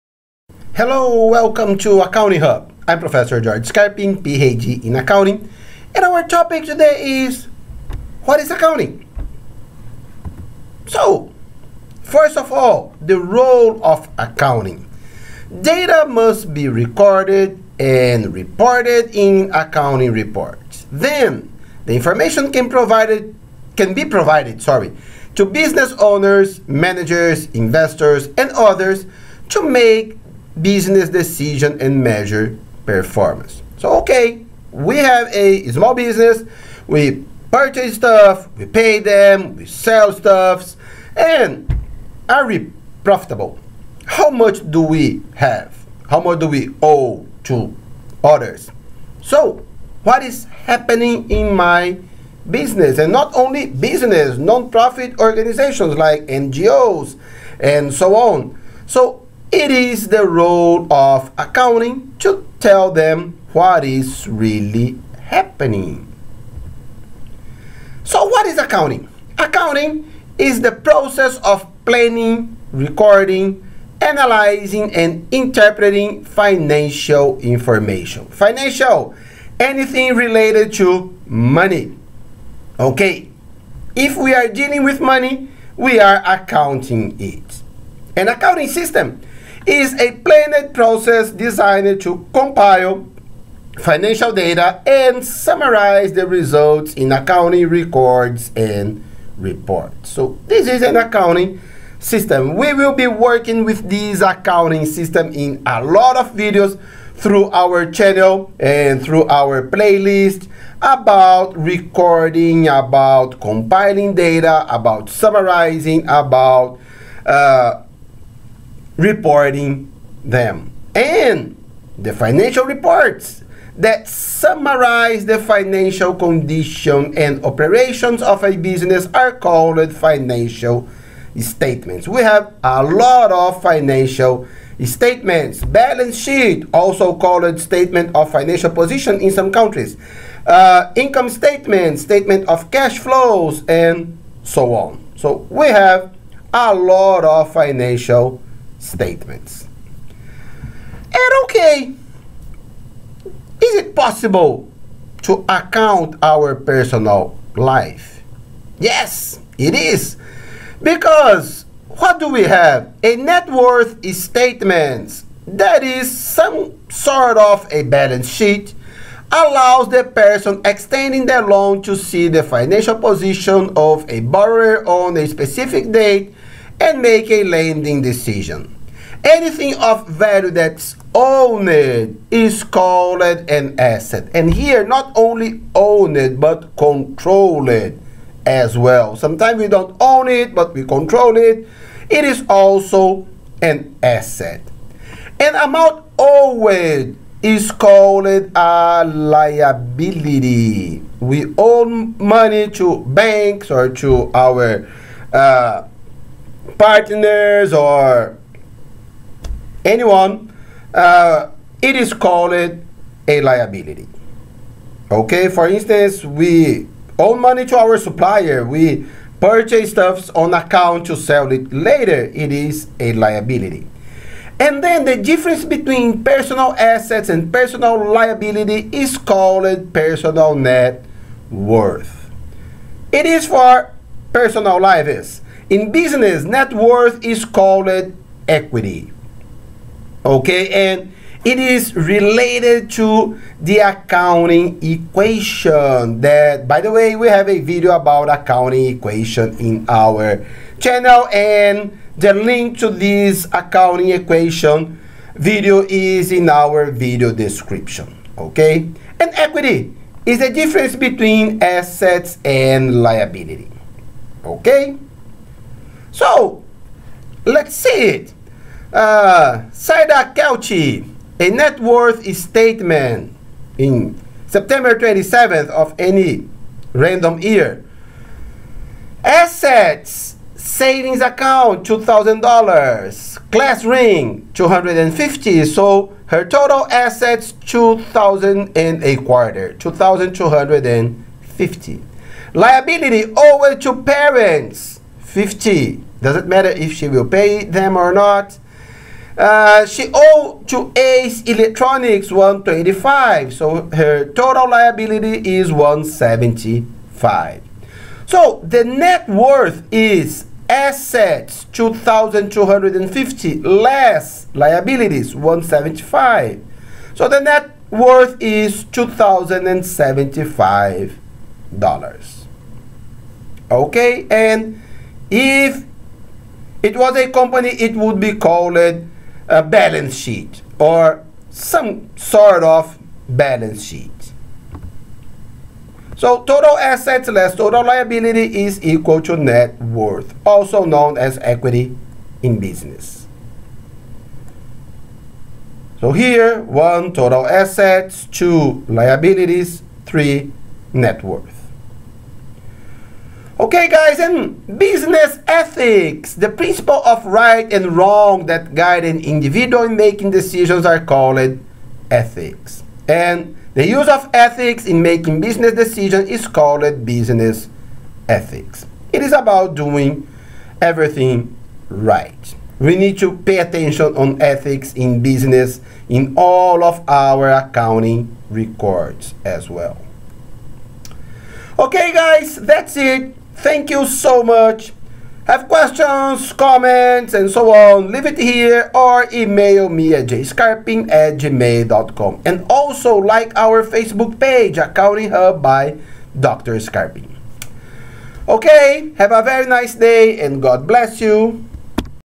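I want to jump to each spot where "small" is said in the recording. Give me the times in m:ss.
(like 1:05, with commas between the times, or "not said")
0:35.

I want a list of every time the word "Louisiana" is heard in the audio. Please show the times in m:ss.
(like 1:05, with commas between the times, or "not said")
not said.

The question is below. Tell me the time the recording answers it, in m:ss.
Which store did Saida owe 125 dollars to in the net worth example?
5:00.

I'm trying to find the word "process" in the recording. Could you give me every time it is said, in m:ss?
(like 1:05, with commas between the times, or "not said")
1:10, 1:30.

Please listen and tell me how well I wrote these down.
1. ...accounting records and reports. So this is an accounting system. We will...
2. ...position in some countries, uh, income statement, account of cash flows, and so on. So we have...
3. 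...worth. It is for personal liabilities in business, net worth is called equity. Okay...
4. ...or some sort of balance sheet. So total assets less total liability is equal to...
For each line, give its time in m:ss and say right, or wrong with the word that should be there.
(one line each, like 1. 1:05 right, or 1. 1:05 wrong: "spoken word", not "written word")
1. 1:37 right
2. 2:18 wrong: "statement", not "account"
3. 3:51 right
4. 5:30 right.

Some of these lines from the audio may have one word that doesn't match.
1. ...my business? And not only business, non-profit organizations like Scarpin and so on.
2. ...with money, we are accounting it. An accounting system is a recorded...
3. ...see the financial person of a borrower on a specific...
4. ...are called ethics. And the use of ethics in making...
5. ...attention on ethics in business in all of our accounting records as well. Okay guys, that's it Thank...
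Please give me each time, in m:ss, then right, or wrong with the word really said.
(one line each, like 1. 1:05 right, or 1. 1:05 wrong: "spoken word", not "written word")
1. 0:51 wrong: "NGOs", not "Scarpin"
2. 1:24 wrong: "planned", not "recorded"
3. 2:51 wrong: "position", not "person"
4. 6:00 right
5. 6:13 right.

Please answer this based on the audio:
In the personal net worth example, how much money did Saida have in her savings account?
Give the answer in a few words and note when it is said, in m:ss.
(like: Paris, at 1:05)
$2,000, at 4:40.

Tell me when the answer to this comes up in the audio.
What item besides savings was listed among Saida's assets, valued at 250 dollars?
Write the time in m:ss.
4:43.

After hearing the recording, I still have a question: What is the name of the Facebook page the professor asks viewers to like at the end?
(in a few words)
Accounting Hub by Dr. 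Scarpin.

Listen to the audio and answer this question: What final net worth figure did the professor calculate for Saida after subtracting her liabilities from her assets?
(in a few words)
$2,075.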